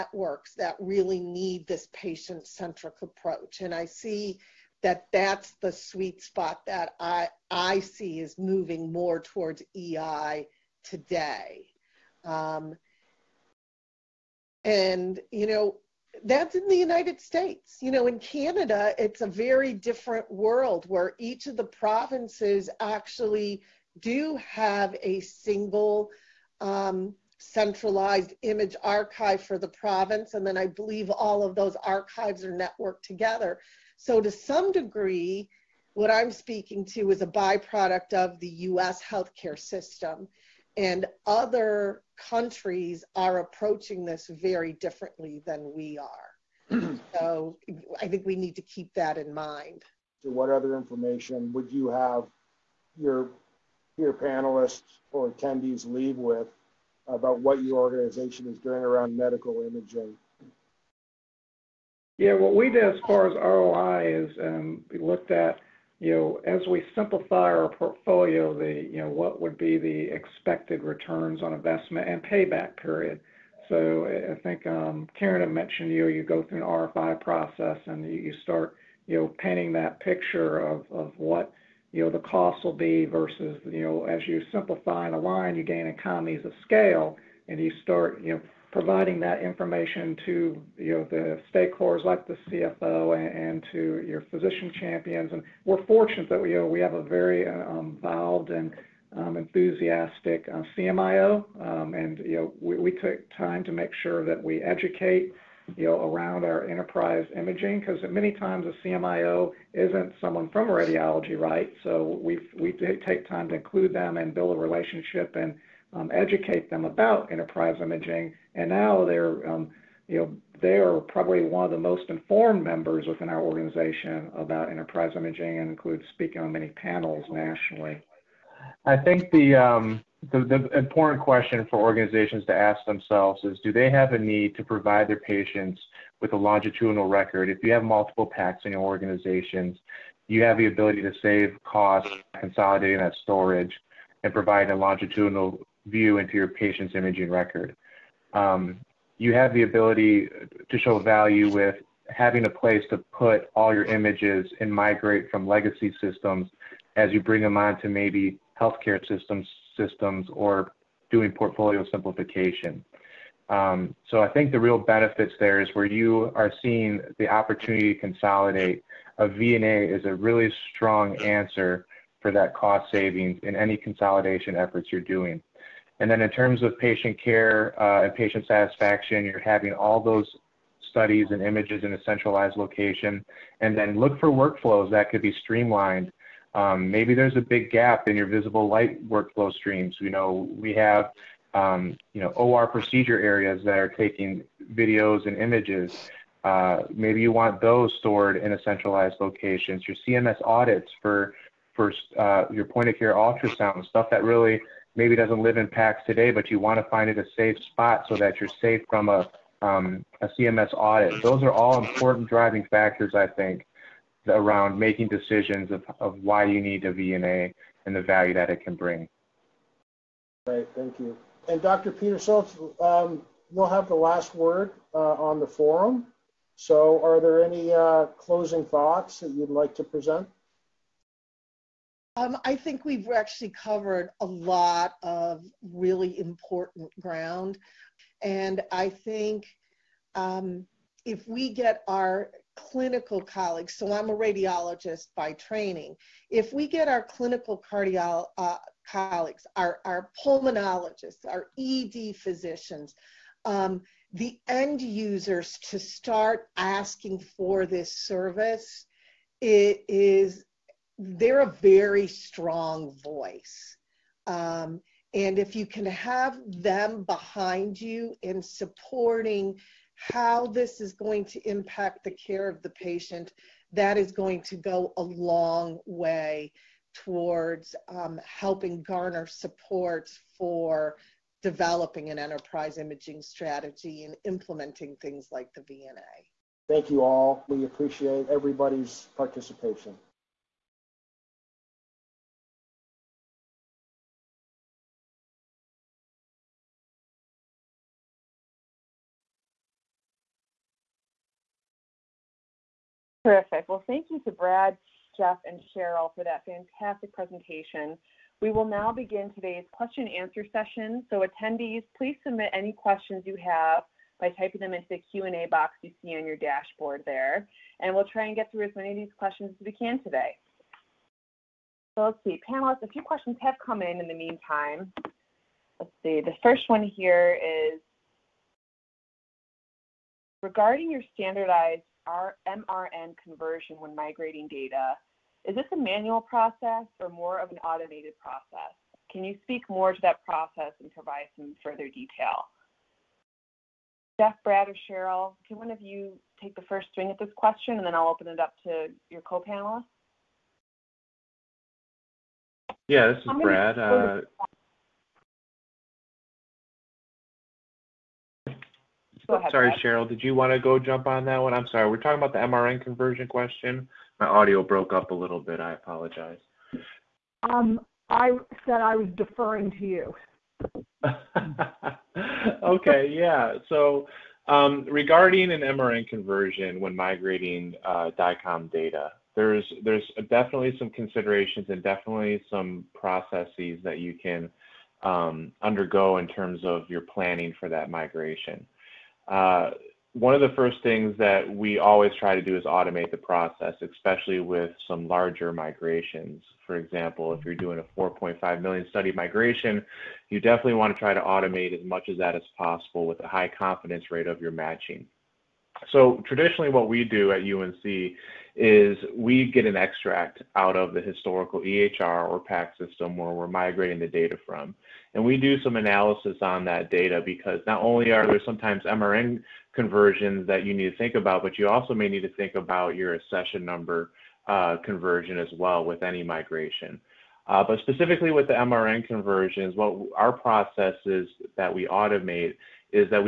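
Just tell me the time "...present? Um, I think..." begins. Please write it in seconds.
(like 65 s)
229 s.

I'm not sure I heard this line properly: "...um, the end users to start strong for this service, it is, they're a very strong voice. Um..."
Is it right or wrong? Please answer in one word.
wrong.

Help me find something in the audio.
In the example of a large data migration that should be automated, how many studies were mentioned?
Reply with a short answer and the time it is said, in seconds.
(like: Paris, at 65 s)
4.5 million, at 397 s.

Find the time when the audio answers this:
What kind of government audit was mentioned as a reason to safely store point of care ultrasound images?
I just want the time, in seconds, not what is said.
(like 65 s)
210 s.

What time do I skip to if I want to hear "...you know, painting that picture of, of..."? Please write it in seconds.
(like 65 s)
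79 s.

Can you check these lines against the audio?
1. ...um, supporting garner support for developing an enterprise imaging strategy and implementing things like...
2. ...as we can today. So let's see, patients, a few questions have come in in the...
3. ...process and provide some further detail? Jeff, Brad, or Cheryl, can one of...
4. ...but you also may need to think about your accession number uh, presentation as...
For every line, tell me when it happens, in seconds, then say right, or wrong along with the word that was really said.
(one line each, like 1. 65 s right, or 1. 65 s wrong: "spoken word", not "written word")
1. 277 s wrong: "helping", not "supporting"
2. 319 s wrong: "panelists", not "patients"
3. 340 s right
4. 421 s wrong: "conversion", not "presentation".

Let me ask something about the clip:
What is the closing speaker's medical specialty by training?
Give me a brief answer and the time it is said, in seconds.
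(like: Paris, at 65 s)
Radiologist, at 244 s.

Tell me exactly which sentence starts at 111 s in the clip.
So we we take time to include them and build a relationship and um, educate them about enterprise imaging.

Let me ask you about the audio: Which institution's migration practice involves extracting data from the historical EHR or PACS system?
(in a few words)
UNC.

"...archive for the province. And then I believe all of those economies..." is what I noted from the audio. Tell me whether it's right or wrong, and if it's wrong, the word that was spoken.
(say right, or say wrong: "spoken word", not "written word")
wrong: "archives", not "economies".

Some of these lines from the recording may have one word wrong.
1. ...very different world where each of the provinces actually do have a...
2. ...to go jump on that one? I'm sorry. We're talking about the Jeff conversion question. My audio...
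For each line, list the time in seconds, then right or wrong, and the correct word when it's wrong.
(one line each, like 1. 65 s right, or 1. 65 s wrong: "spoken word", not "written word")
1. 19 s right
2. 360 s wrong: "MRN", not "Jeff".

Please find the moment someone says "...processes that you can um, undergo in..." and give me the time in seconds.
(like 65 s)
382 s.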